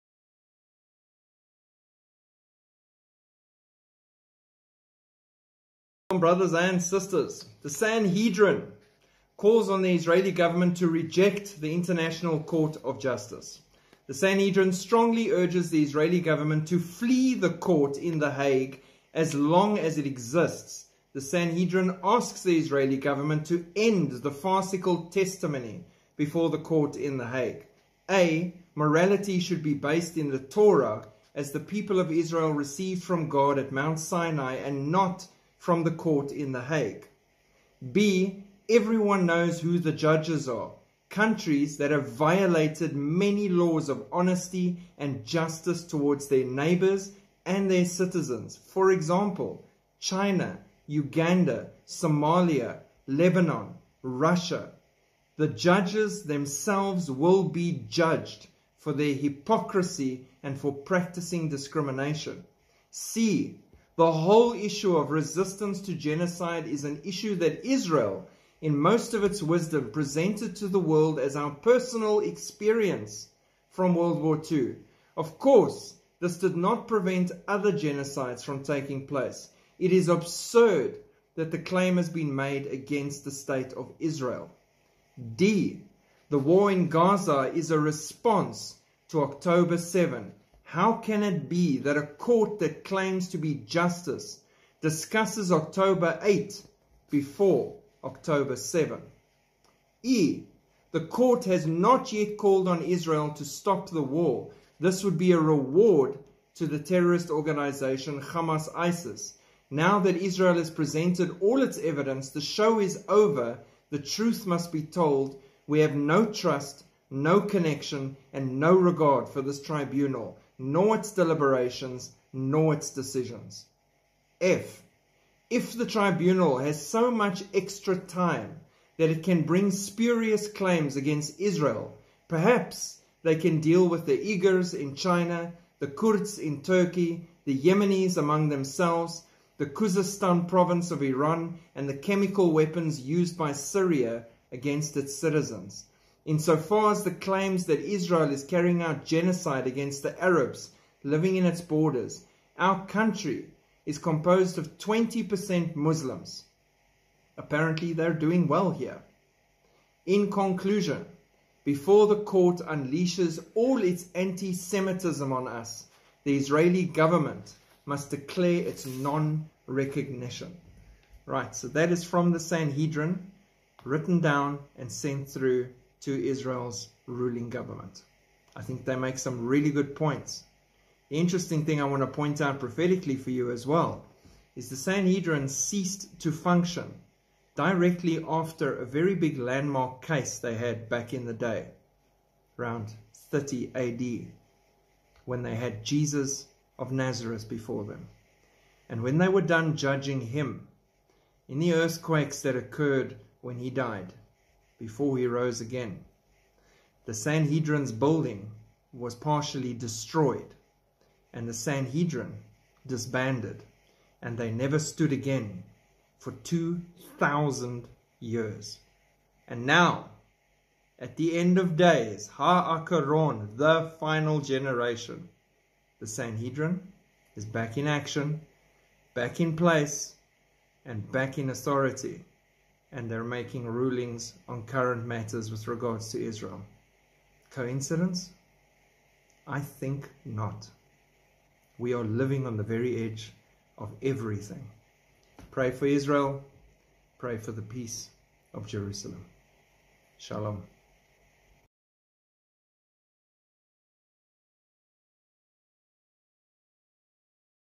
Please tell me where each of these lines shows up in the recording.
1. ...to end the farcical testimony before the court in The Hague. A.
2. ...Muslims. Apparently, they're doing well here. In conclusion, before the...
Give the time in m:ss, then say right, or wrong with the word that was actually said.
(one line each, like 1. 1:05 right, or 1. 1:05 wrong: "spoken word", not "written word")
1. 0:23 right
2. 2:35 right.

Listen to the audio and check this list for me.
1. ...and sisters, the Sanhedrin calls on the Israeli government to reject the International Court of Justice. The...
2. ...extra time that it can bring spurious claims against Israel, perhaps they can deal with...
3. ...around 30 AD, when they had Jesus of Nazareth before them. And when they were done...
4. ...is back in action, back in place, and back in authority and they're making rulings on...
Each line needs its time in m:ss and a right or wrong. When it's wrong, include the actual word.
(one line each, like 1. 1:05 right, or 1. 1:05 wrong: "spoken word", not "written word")
1. 0:06 right
2. 2:07 right
3. 3:12 right
4. 3:47 right.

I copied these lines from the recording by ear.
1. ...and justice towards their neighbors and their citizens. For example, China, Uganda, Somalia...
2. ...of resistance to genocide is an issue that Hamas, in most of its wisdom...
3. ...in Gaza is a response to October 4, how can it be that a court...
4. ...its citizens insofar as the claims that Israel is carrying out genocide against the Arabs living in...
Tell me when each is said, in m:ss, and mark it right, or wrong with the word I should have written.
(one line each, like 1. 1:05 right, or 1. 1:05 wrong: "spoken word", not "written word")
1. 0:44 right
2. 1:04 wrong: "Israel", not "Hamas"
3. 1:26 wrong: "7", not "4"
4. 2:24 right.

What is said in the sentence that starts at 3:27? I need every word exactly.
The Sanhedrin's building was partially destroyed, and the Sanhedrin disbanded, and they never stood again for 2,000 years.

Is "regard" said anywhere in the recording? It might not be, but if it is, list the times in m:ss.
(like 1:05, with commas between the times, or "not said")
1:58, 3:55.